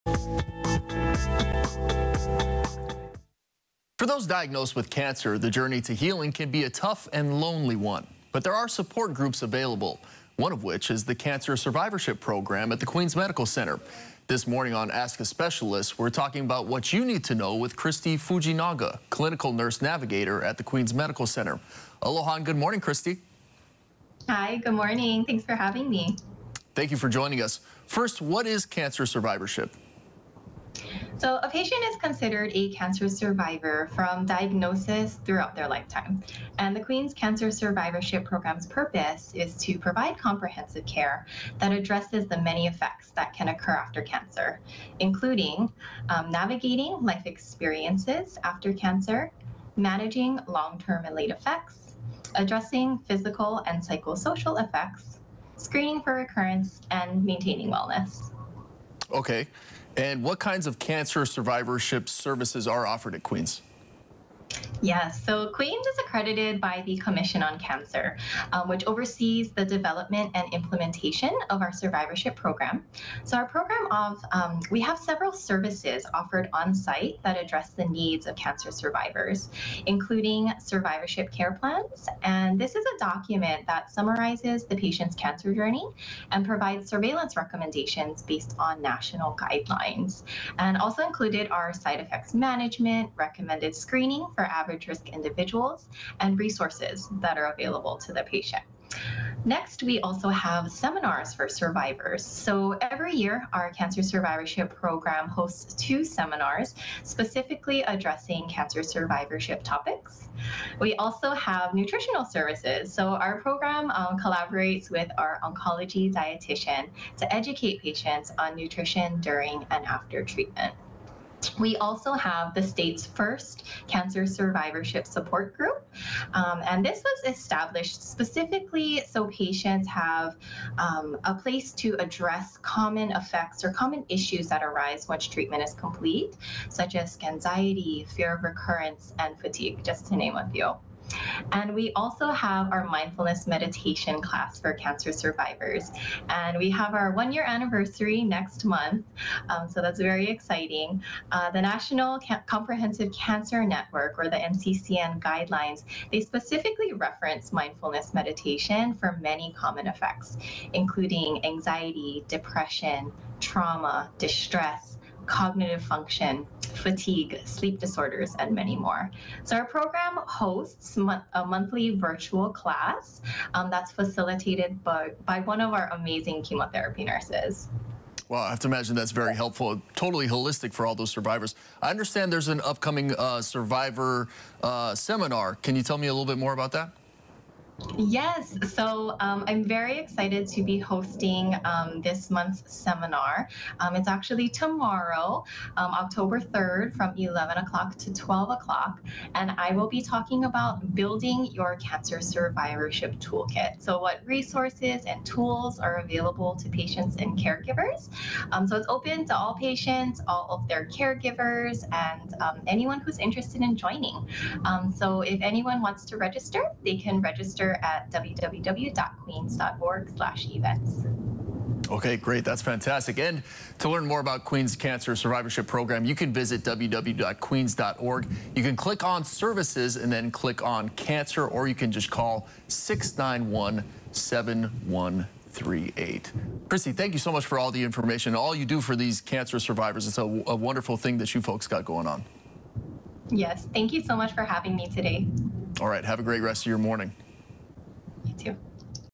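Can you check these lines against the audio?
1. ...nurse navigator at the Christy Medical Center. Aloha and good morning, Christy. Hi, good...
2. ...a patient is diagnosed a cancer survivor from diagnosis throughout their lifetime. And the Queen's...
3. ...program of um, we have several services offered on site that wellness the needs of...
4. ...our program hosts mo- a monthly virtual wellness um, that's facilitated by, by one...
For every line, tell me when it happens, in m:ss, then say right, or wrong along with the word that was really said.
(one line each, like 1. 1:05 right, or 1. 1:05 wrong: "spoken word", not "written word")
1. 0:19 wrong: "Queens", not "Christy"
2. 0:31 wrong: "considered", not "diagnosed"
3. 1:13 wrong: "address", not "wellness"
4. 2:49 wrong: "class", not "wellness".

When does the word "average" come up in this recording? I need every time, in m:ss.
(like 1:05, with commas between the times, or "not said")
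1:34.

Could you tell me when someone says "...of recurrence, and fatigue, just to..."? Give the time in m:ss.
2:18.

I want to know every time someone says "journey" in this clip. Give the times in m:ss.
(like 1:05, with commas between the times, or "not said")
0:05, 1:25.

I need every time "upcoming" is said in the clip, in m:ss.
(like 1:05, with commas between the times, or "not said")
3:02.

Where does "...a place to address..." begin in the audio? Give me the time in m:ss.
2:11.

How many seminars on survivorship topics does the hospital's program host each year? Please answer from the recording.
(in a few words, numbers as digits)
2.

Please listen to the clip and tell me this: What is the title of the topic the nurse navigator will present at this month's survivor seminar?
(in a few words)
Building your cancer survivorship toolkit.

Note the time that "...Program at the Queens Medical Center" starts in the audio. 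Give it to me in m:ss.
0:12.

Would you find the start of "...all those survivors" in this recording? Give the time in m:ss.
3:00.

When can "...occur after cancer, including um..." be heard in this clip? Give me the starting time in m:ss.
0:43.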